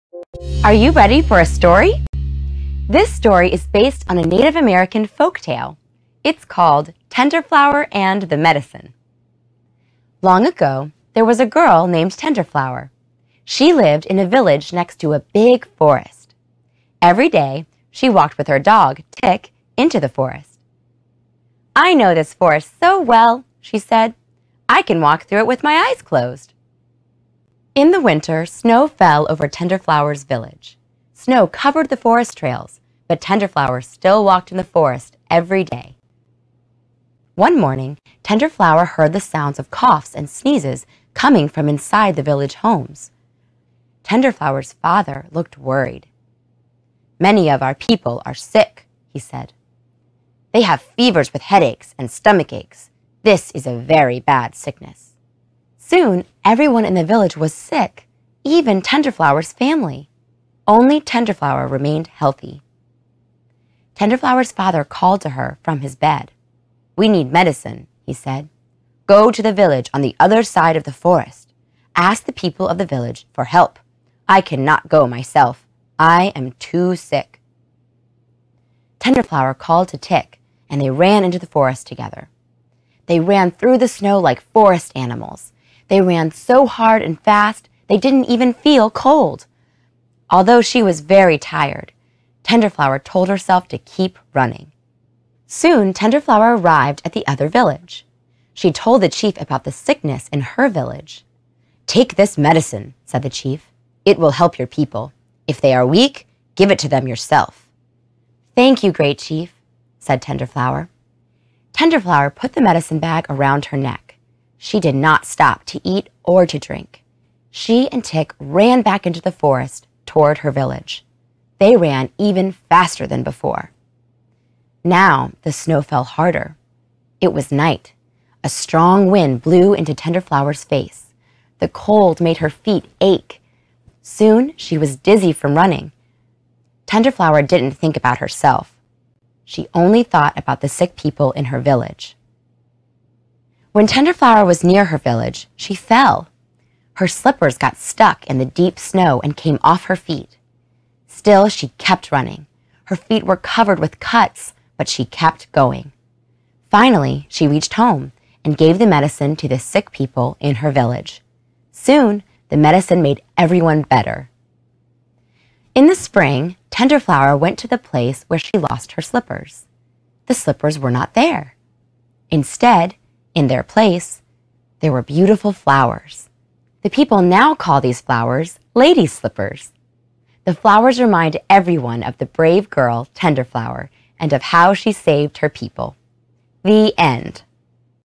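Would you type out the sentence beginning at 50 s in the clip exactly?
They have fevers with headaches and stomach aches.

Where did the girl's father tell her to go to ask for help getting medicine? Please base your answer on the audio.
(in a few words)
The village on the other side of the forest.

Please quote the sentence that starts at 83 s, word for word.
They ran through the snow like forest animals, they ran so hard and fast, they didn't even feel cold.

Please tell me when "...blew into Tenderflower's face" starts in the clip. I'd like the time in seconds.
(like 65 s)
129 s.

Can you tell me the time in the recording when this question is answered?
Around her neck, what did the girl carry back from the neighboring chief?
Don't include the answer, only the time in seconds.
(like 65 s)
112 s.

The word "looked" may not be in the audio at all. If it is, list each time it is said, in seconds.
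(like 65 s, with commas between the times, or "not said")
45 s.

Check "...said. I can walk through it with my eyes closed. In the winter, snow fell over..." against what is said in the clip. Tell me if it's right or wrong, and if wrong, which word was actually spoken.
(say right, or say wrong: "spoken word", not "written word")
right.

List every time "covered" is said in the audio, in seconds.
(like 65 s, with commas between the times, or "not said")
31 s, 153 s.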